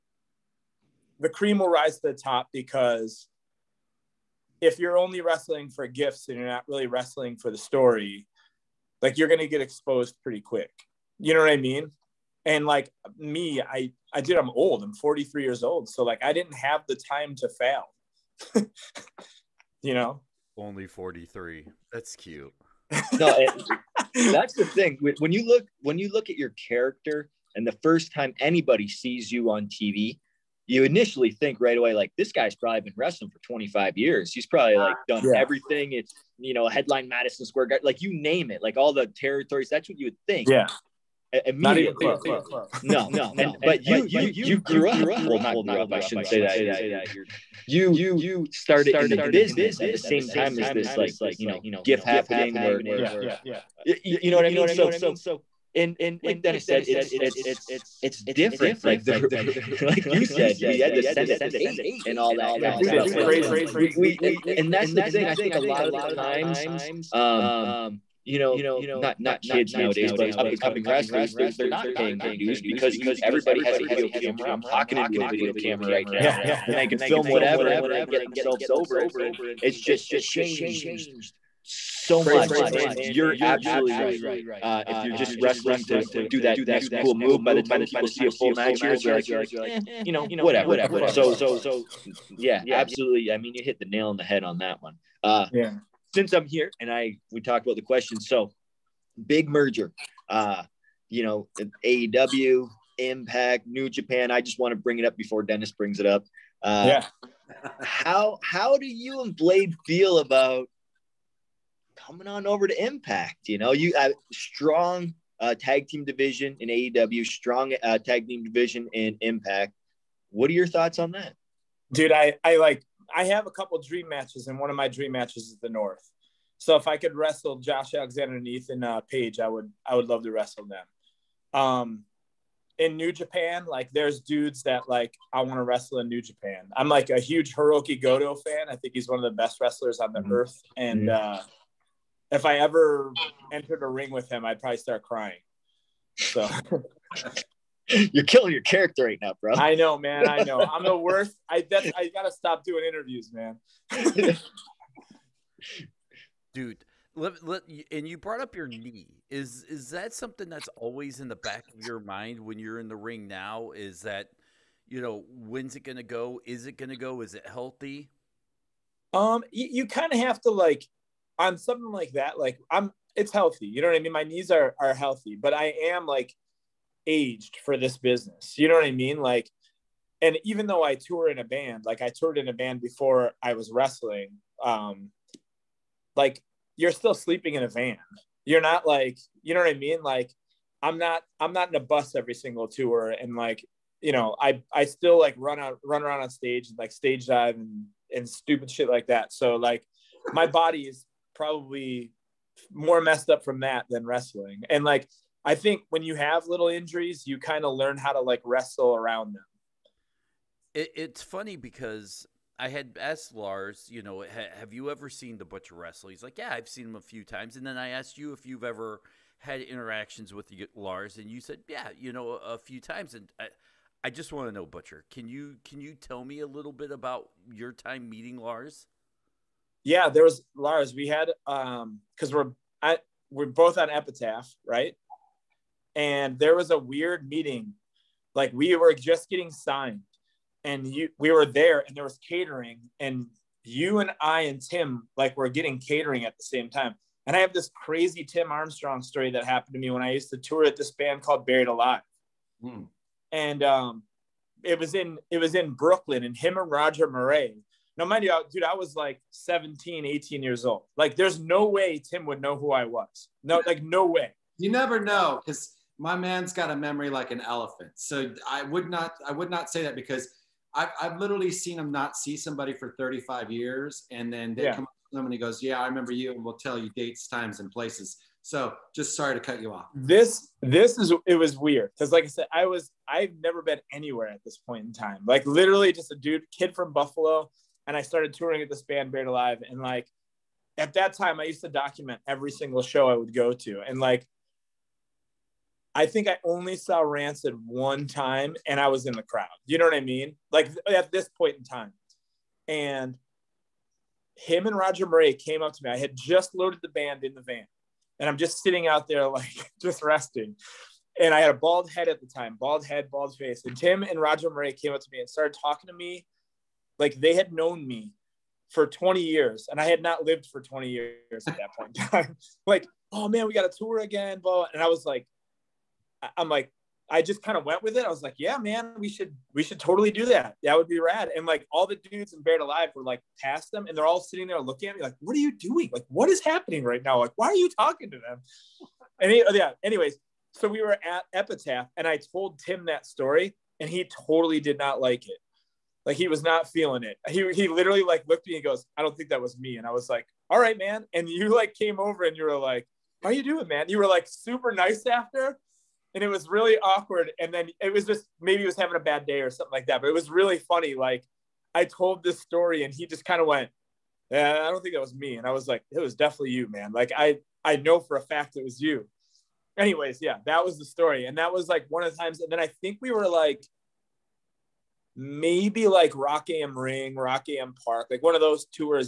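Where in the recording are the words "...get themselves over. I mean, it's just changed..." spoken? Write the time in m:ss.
1:18.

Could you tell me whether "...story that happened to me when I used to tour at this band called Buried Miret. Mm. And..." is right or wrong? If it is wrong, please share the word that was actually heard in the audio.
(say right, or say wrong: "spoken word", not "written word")
wrong: "Alive", not "Miret".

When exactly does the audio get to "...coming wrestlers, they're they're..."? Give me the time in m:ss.
1:10.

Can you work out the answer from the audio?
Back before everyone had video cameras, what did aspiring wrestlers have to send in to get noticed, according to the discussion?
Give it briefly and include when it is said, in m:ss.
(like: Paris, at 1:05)
A tape, at 1:01.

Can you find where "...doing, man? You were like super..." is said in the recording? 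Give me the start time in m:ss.
5:53.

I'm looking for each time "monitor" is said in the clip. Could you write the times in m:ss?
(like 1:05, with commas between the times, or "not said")
not said.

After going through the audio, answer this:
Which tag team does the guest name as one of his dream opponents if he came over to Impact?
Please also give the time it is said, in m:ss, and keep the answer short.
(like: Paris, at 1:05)
The North, at 2:05.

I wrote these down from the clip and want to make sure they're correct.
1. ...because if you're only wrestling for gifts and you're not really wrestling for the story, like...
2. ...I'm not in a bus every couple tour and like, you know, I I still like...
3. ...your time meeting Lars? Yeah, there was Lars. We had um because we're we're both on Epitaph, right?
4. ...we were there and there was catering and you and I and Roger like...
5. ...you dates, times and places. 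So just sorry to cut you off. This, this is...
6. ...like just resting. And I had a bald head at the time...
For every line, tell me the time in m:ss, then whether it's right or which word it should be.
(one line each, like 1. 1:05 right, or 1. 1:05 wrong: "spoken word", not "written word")
1. 0:02 right
2. 3:11 wrong: "single", not "couple"
3. 3:47 right
4. 4:01 wrong: "Tim", not "Roger"
5. 4:36 right
6. 5:09 right.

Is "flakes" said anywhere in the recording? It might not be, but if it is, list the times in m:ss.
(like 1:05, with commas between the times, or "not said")
not said.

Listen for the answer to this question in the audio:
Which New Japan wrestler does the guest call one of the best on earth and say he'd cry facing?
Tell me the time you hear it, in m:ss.
2:17.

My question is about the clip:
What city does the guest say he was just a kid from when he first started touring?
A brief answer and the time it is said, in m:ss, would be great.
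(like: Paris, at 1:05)
Buffalo, at 4:46.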